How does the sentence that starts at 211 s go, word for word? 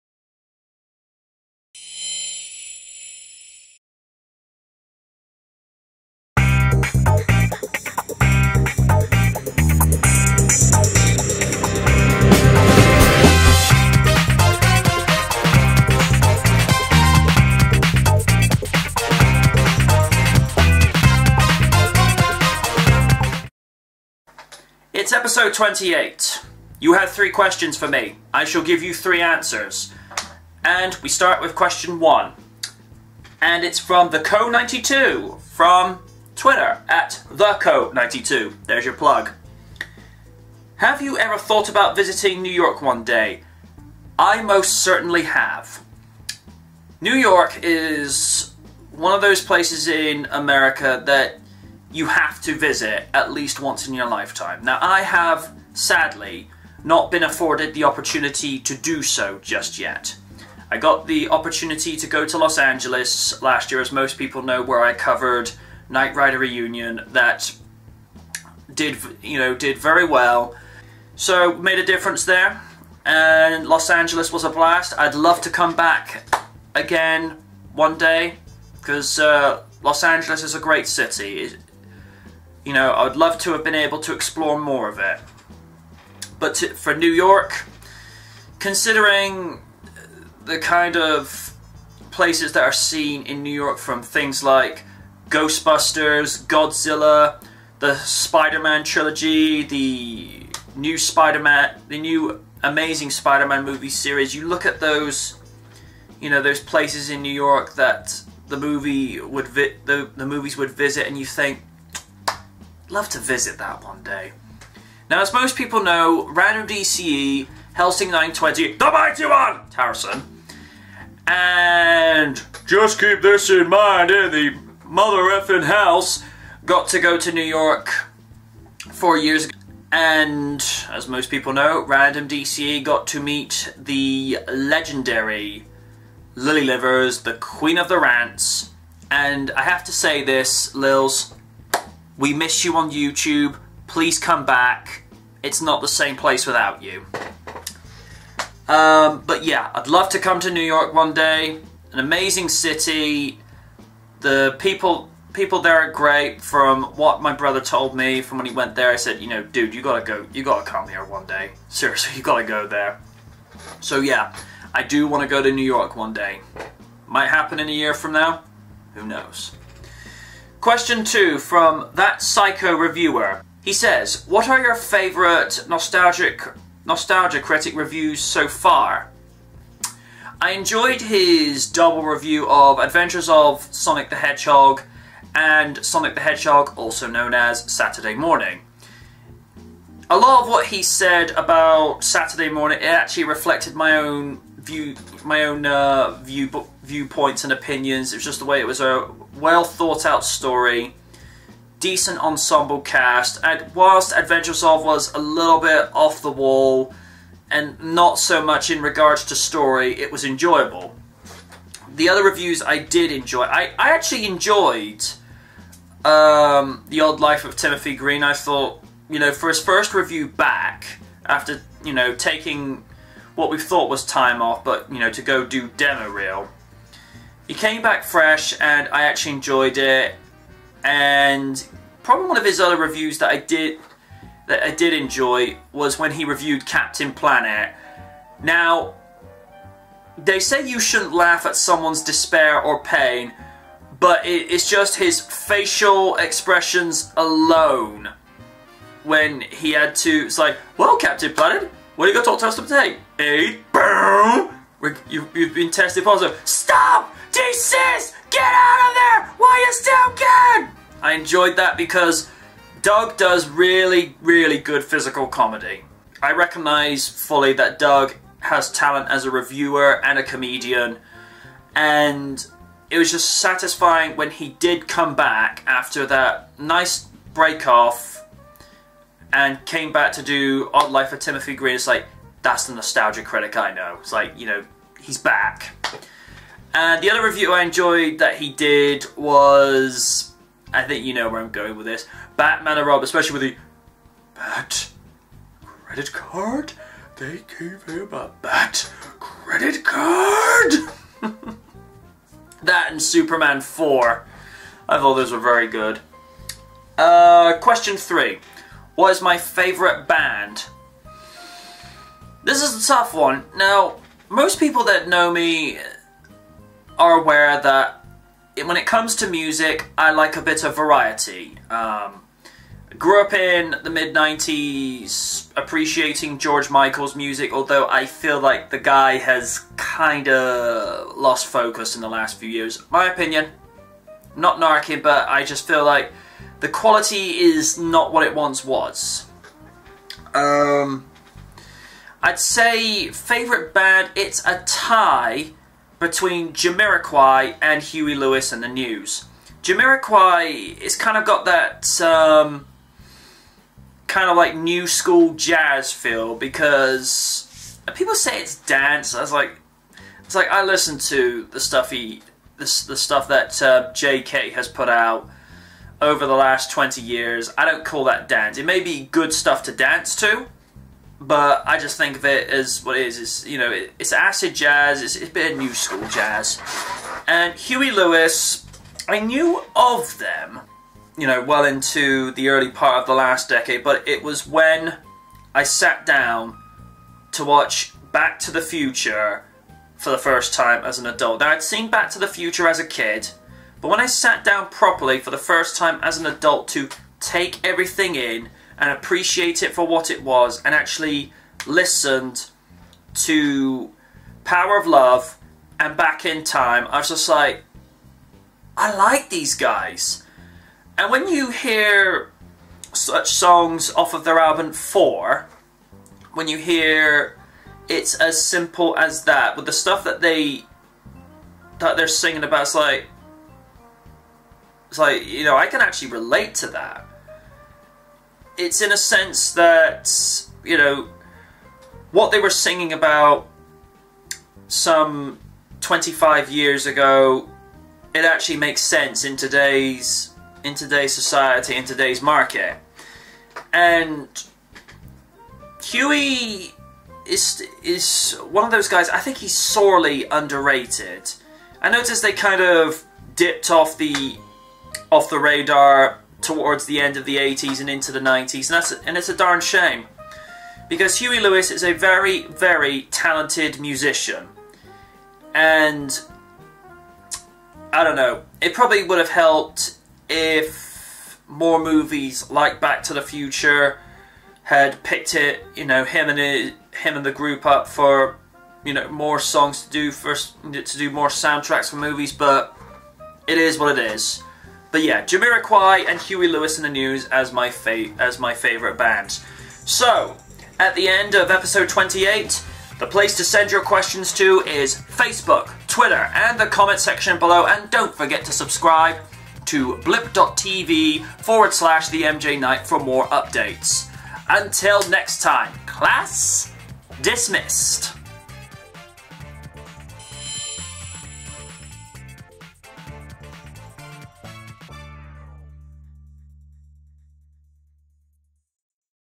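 The other reviews I did enjoy.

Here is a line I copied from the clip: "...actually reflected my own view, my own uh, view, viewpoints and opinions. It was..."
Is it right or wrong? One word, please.
right.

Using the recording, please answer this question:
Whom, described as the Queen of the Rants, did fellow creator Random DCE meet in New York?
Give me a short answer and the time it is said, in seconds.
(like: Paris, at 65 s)
Lily Livers, at 136 s.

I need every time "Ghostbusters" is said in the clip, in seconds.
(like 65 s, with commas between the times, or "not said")
95 s.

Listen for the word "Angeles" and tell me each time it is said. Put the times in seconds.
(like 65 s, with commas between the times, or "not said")
62 s, 73 s, 80 s.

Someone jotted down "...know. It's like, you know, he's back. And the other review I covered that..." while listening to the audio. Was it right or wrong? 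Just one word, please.
wrong.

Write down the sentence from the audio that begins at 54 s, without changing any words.
Now, I have, sadly, not been afforded the opportunity to do so just yet.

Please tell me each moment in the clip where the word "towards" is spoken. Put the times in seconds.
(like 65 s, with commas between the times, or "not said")
456 s.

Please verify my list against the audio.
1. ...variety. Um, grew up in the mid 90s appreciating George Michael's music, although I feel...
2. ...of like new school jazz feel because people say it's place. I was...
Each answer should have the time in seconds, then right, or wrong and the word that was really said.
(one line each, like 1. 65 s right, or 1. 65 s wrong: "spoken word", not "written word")
1. 320 s right
2. 354 s wrong: "dance", not "place".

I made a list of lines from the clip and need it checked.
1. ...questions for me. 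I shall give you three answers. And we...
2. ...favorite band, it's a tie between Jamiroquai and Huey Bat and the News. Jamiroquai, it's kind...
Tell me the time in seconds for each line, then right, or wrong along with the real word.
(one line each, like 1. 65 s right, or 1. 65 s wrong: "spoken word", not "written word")
1. 27 s right
2. 343 s wrong: "Lewis", not "Bat".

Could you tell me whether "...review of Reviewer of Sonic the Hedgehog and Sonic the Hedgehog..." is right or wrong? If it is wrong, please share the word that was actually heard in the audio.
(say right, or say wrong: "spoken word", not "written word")
wrong: "Adventures", not "Reviewer".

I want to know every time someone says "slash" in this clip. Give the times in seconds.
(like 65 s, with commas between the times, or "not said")
501 s.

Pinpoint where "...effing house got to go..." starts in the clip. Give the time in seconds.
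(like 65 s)
125 s.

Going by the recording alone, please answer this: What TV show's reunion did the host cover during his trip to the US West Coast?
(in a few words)
Knight Rider.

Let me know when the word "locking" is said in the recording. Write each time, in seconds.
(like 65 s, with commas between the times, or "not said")
not said.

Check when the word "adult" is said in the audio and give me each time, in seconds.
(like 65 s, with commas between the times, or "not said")
391 s, 396 s.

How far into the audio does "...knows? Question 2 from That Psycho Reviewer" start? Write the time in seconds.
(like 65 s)
169 s.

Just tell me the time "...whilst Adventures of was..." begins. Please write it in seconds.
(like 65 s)
203 s.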